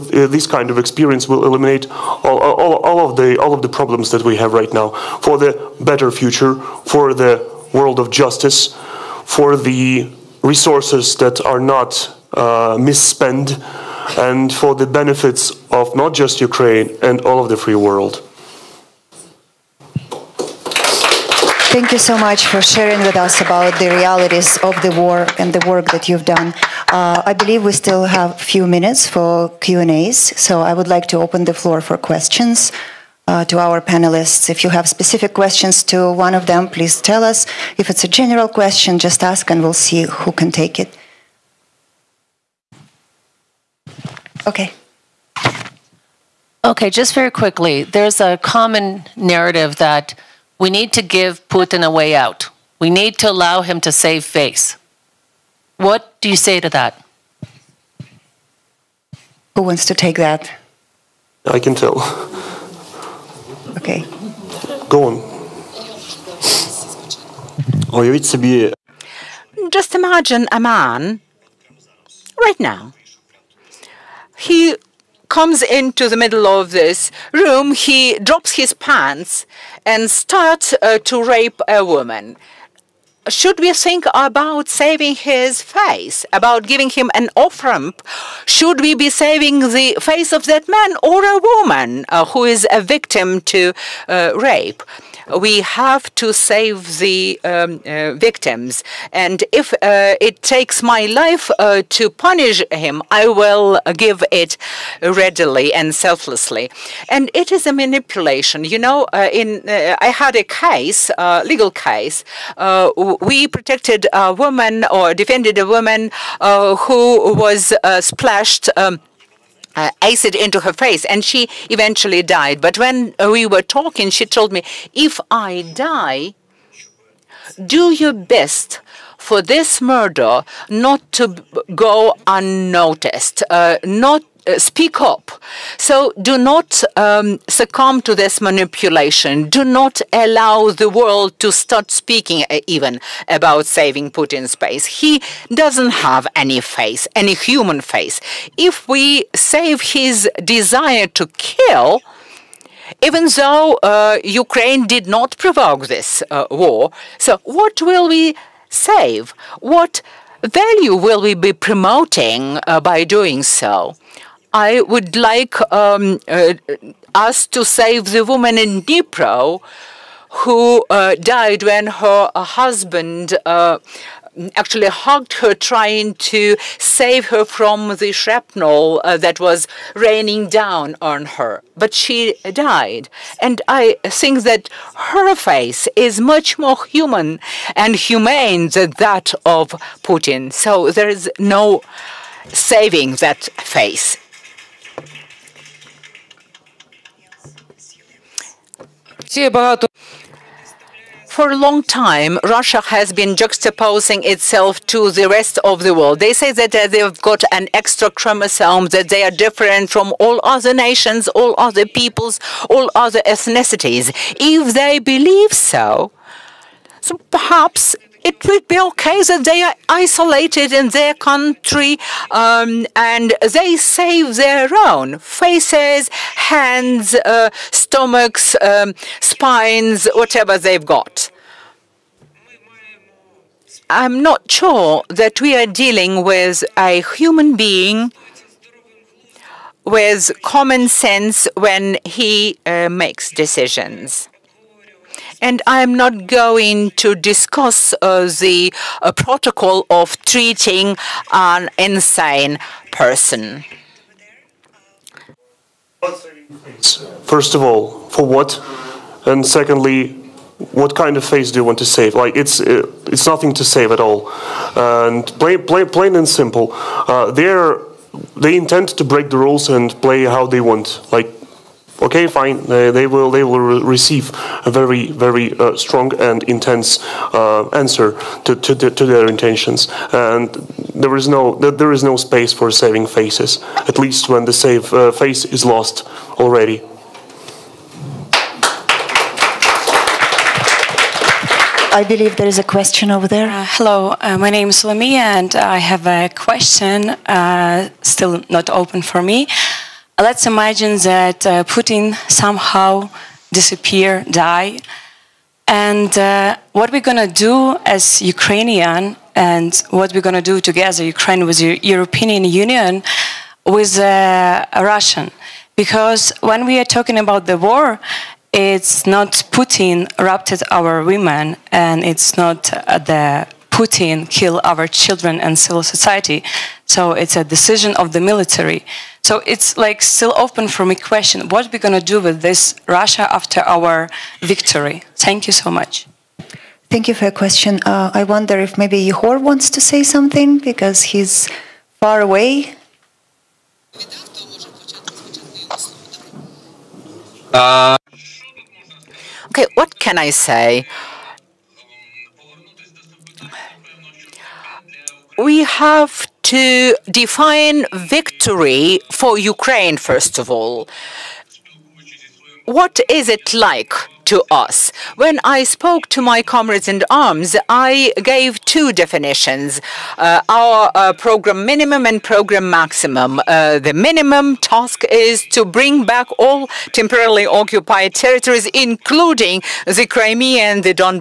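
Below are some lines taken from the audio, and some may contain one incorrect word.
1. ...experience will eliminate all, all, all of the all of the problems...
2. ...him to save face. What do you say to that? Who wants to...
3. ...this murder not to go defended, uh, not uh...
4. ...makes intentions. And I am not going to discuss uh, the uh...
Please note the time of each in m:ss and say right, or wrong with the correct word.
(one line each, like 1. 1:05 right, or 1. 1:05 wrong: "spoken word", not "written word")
1. 0:00 right
2. 0:53 right
3. 2:09 wrong: "unnoticed", not "defended"
4. 4:02 wrong: "decisions", not "intentions".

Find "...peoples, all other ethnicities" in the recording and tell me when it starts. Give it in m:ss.
3:31.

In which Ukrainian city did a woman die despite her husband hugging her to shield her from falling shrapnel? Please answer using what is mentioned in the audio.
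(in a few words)
Dnipro.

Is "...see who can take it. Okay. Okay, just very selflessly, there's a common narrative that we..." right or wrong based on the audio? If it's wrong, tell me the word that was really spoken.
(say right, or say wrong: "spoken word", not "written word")
wrong: "quickly", not "selflessly".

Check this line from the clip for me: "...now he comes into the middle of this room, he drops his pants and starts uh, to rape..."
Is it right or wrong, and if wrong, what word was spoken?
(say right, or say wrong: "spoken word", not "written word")
right.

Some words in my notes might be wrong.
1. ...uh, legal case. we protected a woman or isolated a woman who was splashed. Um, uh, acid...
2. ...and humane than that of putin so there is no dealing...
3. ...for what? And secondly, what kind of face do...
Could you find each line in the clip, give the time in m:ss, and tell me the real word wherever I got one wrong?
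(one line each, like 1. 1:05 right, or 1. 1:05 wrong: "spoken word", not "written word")
1. 1:51 wrong: "defended", not "isolated"
2. 3:07 wrong: "saving", not "dealing"
3. 4:18 right.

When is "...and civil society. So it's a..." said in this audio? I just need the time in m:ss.
5:25.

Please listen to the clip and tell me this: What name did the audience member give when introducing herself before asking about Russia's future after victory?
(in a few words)
Lamia.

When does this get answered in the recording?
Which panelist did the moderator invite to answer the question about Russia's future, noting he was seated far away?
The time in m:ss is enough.
5:39.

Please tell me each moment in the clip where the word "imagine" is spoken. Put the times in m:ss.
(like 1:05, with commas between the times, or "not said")
1:09, 5:00.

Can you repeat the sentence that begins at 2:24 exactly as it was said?
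He doesn't have any face, any human face.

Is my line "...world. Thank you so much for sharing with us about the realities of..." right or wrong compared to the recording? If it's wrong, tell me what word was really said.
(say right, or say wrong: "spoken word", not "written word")
right.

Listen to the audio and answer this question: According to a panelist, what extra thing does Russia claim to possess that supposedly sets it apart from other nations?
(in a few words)
An extra chromosome.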